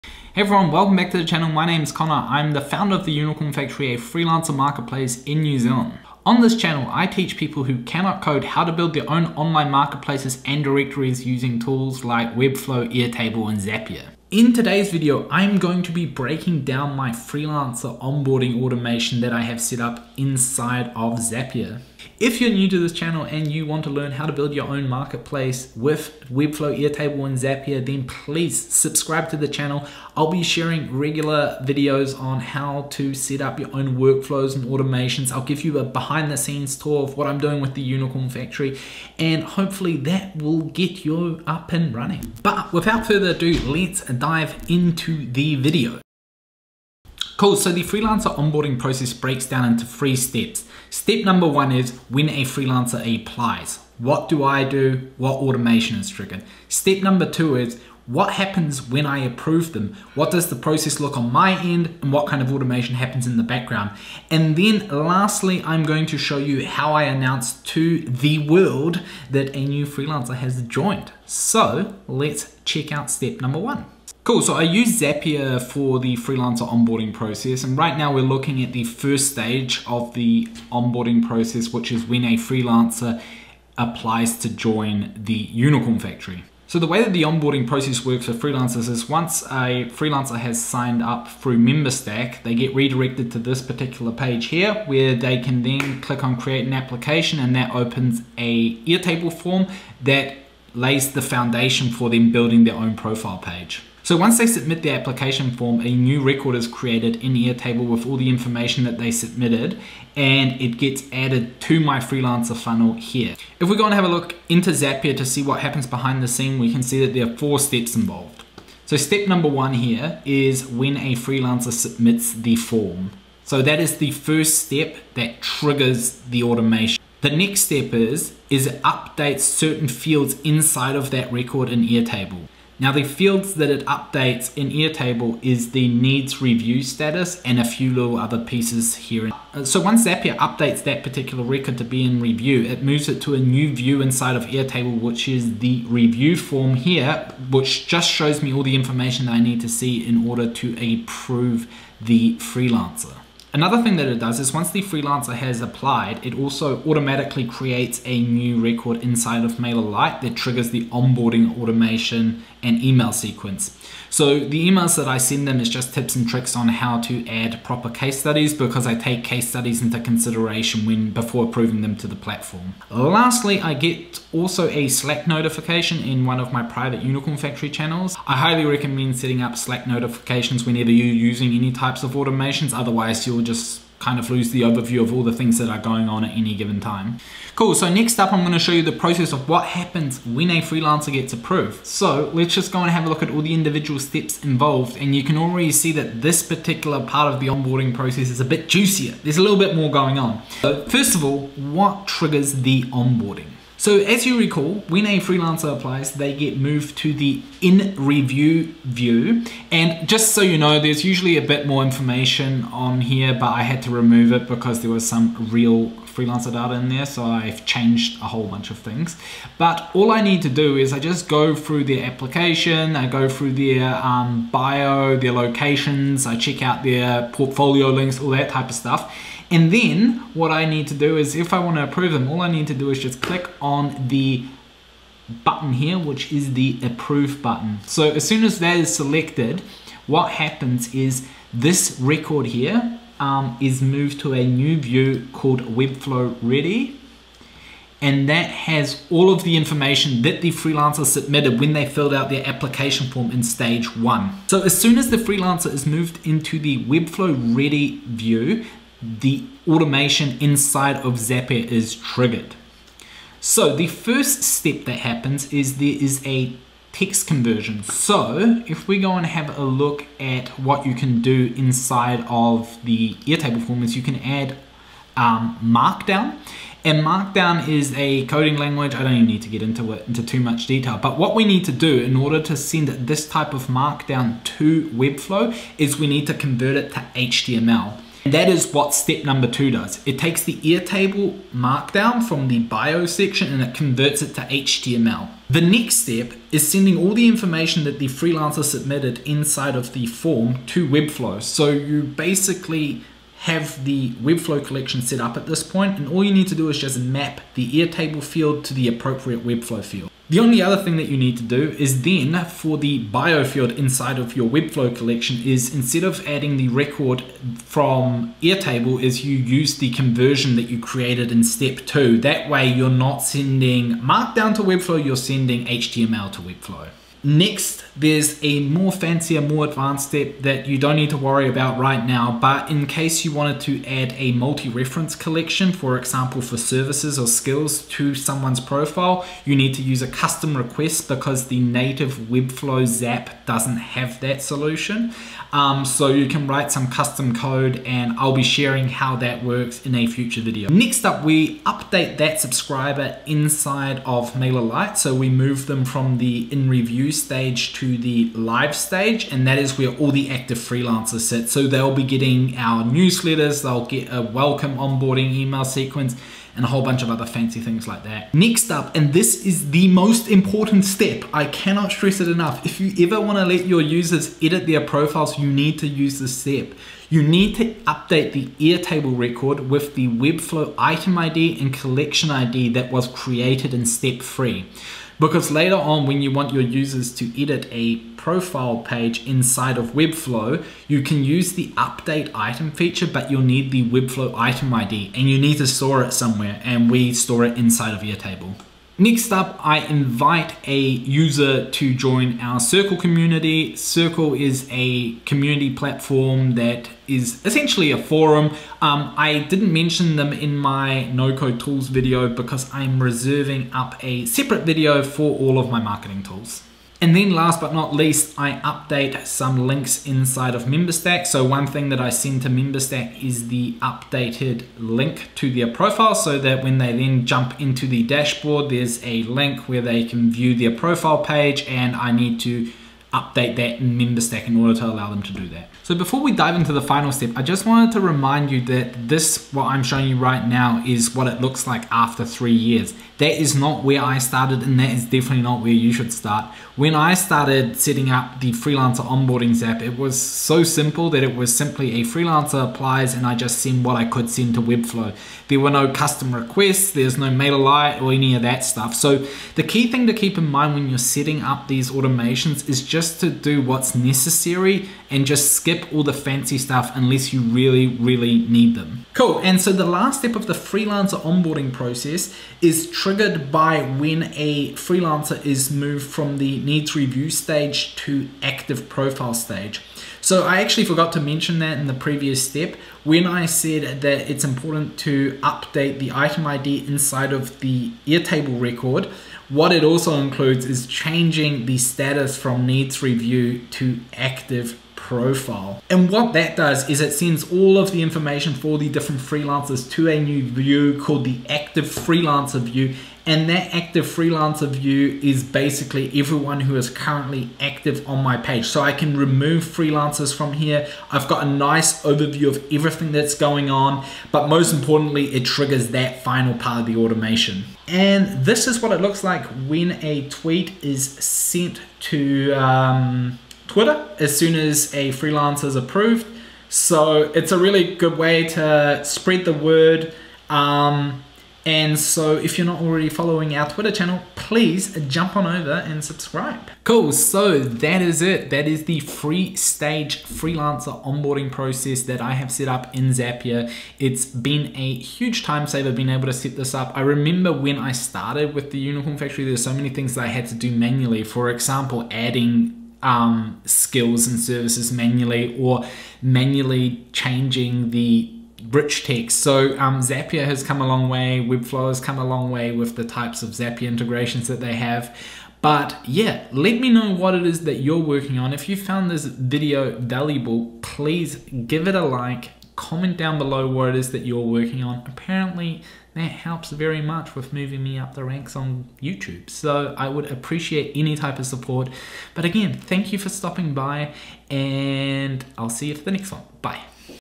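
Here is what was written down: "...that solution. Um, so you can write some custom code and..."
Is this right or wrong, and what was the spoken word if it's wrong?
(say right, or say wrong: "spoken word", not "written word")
right.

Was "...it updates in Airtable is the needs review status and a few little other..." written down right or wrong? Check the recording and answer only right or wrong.
right.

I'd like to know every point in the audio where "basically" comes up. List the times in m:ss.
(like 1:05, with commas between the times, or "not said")
5:02, 8:25.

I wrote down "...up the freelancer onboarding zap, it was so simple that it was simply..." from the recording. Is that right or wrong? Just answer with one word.
right.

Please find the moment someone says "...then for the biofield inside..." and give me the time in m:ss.
5:12.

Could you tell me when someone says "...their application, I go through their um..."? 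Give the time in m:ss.
3:41.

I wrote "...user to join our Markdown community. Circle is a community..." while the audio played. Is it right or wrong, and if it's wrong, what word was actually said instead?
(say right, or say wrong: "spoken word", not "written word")
wrong: "Circle", not "Markdown".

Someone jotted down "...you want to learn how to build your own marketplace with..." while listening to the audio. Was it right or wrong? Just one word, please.
right.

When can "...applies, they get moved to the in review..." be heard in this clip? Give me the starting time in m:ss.
3:25.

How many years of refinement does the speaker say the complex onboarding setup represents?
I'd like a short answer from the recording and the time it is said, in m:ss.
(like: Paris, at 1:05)
3 years, at 7:21.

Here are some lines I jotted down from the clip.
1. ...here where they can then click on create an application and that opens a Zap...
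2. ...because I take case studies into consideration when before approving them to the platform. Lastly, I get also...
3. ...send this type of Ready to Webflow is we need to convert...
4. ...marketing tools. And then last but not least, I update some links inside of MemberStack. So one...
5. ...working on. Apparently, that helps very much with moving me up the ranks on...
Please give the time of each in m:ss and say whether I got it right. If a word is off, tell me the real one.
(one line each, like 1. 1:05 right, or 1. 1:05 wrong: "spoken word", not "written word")
1. 1:34 wrong: "Airtable", not "Zap"
2. 2:48 right
3. 4:42 wrong: "Markdown", not "Ready"
4. 6:55 right
5. 9:34 right.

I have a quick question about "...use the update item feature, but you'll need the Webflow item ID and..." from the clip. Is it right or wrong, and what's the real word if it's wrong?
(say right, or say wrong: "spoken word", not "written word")
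right.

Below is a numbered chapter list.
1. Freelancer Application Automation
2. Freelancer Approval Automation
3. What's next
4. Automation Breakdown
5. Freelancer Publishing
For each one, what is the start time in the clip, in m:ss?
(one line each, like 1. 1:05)
1. 1:14
2. 3:07
3. 9:13
4. 0:46
5. 7:33.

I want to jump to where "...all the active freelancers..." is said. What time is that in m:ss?
5:59.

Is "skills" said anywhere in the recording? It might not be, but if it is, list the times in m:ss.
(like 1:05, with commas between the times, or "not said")
5:37, 9:13.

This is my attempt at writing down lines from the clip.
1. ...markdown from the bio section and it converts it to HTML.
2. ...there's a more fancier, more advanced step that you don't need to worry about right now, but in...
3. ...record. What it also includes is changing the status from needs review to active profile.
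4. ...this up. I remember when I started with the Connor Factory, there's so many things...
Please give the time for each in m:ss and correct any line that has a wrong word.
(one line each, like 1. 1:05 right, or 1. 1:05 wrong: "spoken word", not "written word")
1. 4:51 right
2. 5:27 right
3. 8:08 right
4. 9:06 wrong: "Unicorn", not "Connor".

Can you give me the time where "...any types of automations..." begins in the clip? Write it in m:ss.
3:01.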